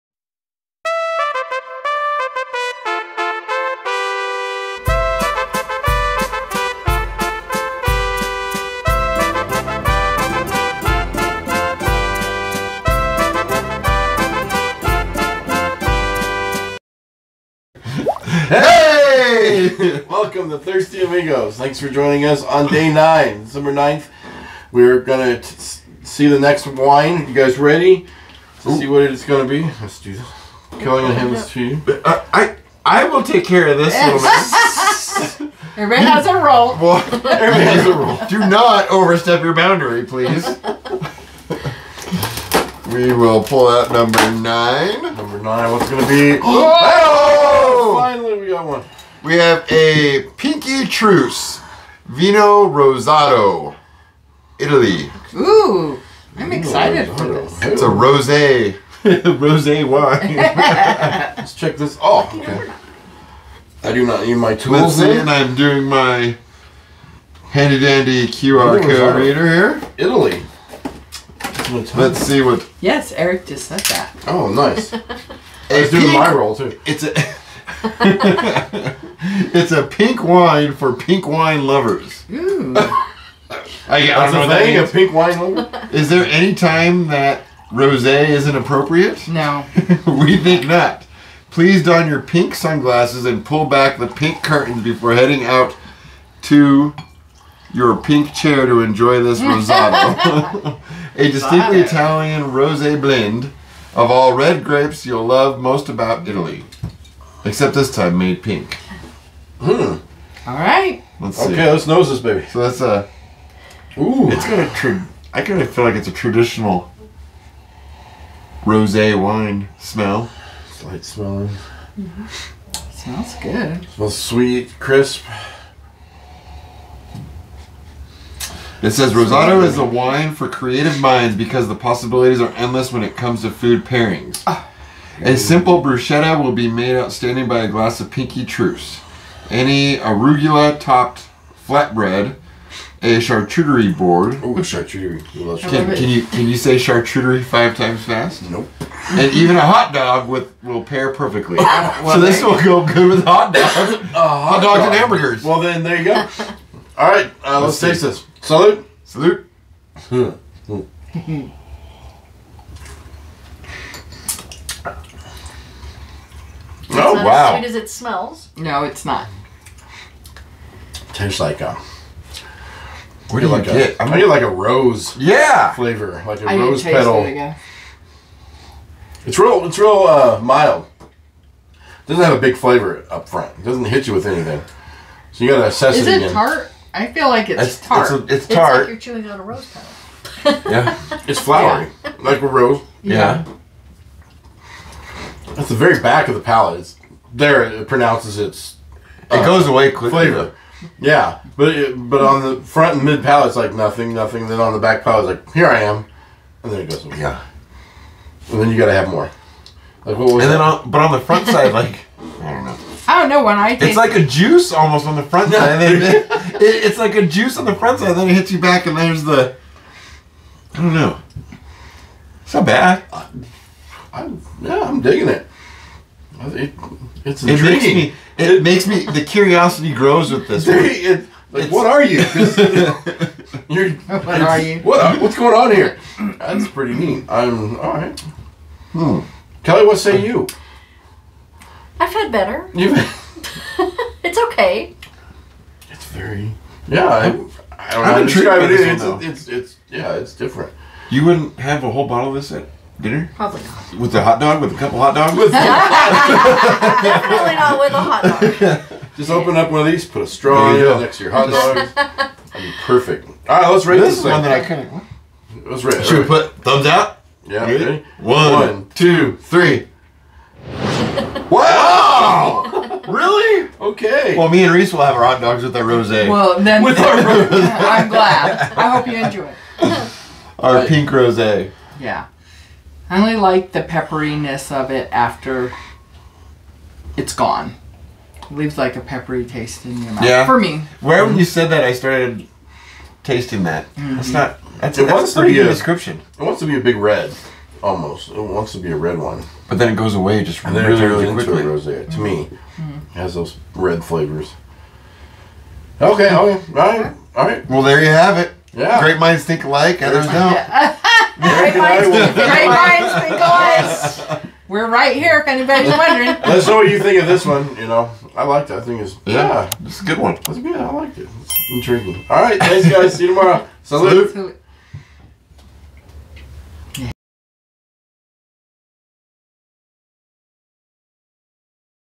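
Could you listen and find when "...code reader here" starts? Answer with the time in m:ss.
1:08.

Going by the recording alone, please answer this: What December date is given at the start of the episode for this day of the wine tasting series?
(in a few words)
December 9th.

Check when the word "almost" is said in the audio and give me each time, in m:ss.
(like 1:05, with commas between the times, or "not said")
3:34, 4:57.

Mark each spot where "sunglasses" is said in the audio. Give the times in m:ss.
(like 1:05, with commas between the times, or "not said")
1:32.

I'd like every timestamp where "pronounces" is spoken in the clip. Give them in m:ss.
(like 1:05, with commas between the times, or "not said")
3:17.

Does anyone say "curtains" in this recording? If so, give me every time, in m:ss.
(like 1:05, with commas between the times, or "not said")
1:34.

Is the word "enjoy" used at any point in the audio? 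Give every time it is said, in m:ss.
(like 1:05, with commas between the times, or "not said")
1:38, 4:39.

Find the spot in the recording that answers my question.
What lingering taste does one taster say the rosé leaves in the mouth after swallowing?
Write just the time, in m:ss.
4:49.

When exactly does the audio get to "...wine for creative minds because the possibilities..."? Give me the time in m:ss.
2:09.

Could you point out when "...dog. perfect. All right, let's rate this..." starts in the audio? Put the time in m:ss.
4:21.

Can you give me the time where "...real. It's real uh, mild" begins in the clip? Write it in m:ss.
2:59.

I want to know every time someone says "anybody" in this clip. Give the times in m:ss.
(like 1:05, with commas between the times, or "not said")
5:15.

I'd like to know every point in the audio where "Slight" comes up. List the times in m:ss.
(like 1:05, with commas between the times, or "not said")
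2:00.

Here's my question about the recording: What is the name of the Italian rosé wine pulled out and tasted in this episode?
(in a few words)
Pinky Truce Vino Rosato.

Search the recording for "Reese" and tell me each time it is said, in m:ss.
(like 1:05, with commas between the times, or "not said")
4:34.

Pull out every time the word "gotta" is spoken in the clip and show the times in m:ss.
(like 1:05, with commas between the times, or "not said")
3:05, 3:28.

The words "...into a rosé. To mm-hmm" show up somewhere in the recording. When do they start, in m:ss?
5:01.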